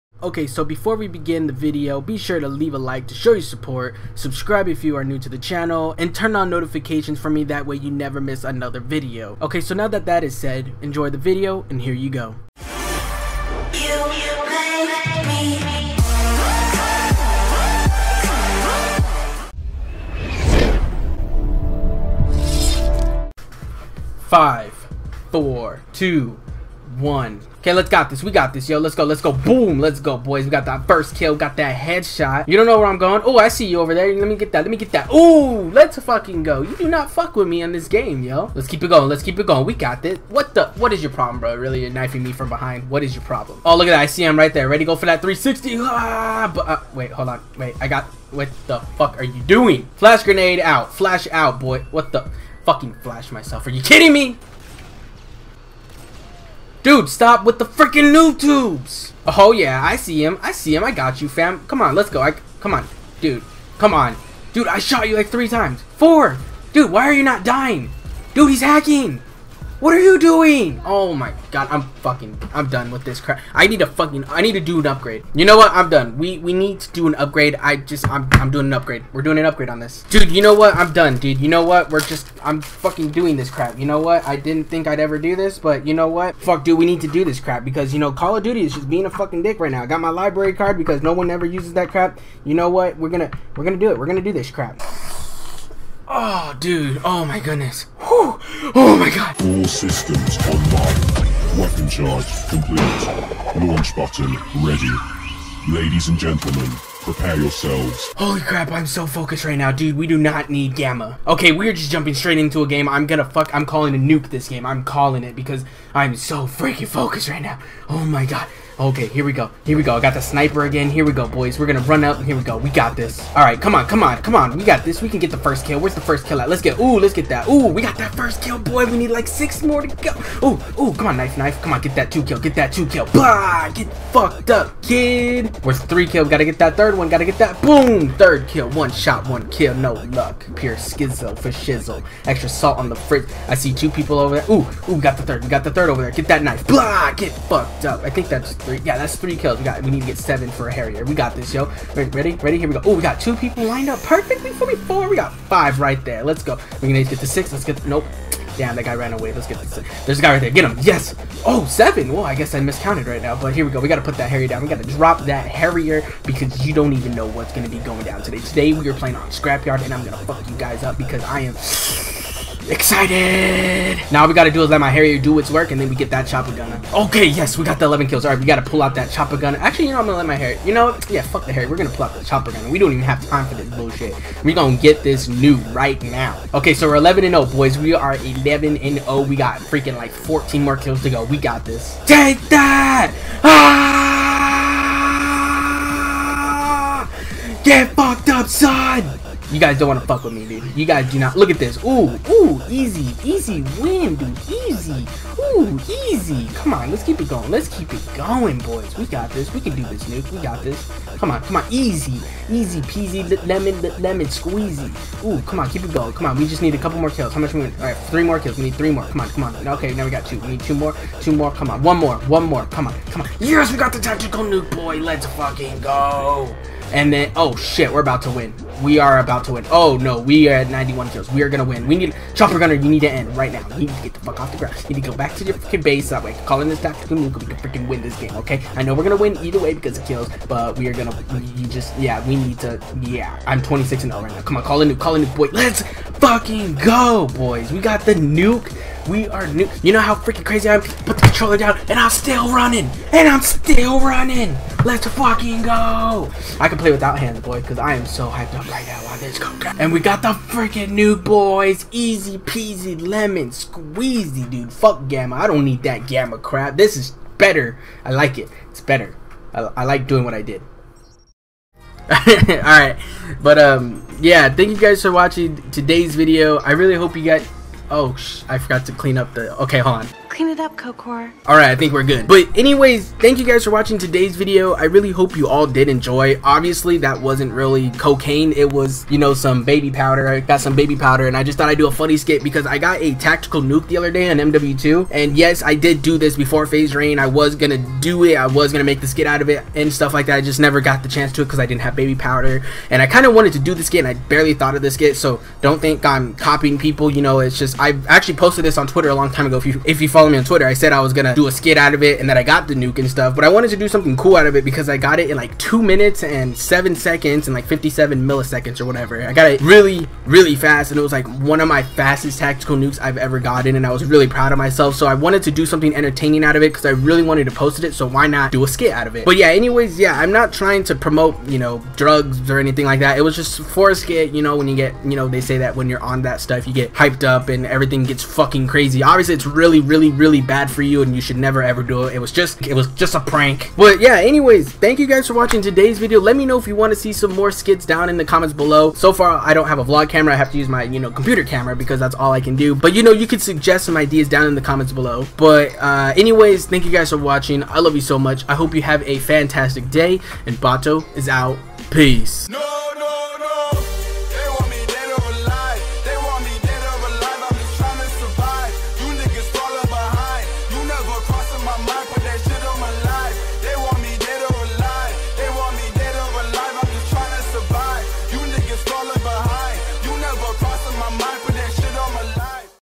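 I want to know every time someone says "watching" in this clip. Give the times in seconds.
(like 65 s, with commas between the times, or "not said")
275 s, 283 s, 345 s, 357 s.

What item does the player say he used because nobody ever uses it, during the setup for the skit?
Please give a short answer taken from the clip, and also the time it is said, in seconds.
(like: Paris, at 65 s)
library card, at 90 s.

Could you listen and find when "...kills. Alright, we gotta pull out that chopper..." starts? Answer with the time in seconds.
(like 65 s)
178 s.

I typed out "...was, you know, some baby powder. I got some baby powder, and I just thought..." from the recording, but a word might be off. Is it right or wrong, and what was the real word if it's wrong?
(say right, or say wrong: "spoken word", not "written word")
right.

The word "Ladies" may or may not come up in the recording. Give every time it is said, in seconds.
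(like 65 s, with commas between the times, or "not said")
105 s.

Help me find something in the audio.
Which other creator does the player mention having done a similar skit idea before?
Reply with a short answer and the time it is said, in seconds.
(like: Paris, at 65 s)
FaZe Rain, at 296 s.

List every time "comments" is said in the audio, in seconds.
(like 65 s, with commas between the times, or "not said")
348 s, 354 s.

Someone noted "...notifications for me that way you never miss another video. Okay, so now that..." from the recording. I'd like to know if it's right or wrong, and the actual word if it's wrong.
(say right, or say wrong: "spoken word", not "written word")
right.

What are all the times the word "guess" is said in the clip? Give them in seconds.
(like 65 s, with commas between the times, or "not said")
162 s.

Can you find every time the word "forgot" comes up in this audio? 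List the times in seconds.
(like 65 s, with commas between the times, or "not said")
278 s.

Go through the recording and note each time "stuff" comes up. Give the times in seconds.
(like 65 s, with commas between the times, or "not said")
299 s, 313 s, 336 s.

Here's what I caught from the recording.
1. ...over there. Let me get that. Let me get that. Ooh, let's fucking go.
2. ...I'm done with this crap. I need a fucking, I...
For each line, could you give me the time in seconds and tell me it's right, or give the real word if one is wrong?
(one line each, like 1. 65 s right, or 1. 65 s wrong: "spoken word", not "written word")
1. 33 s right
2. 72 s right.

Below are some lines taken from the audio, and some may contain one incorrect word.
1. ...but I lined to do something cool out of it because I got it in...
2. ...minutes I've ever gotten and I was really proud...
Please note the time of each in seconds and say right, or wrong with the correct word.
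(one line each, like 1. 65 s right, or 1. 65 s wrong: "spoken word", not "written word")
1. 313 s wrong: "wanted", not "lined"
2. 322 s wrong: "nukes", not "minutes".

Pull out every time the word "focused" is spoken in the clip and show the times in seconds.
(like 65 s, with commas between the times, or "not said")
109 s, 116 s.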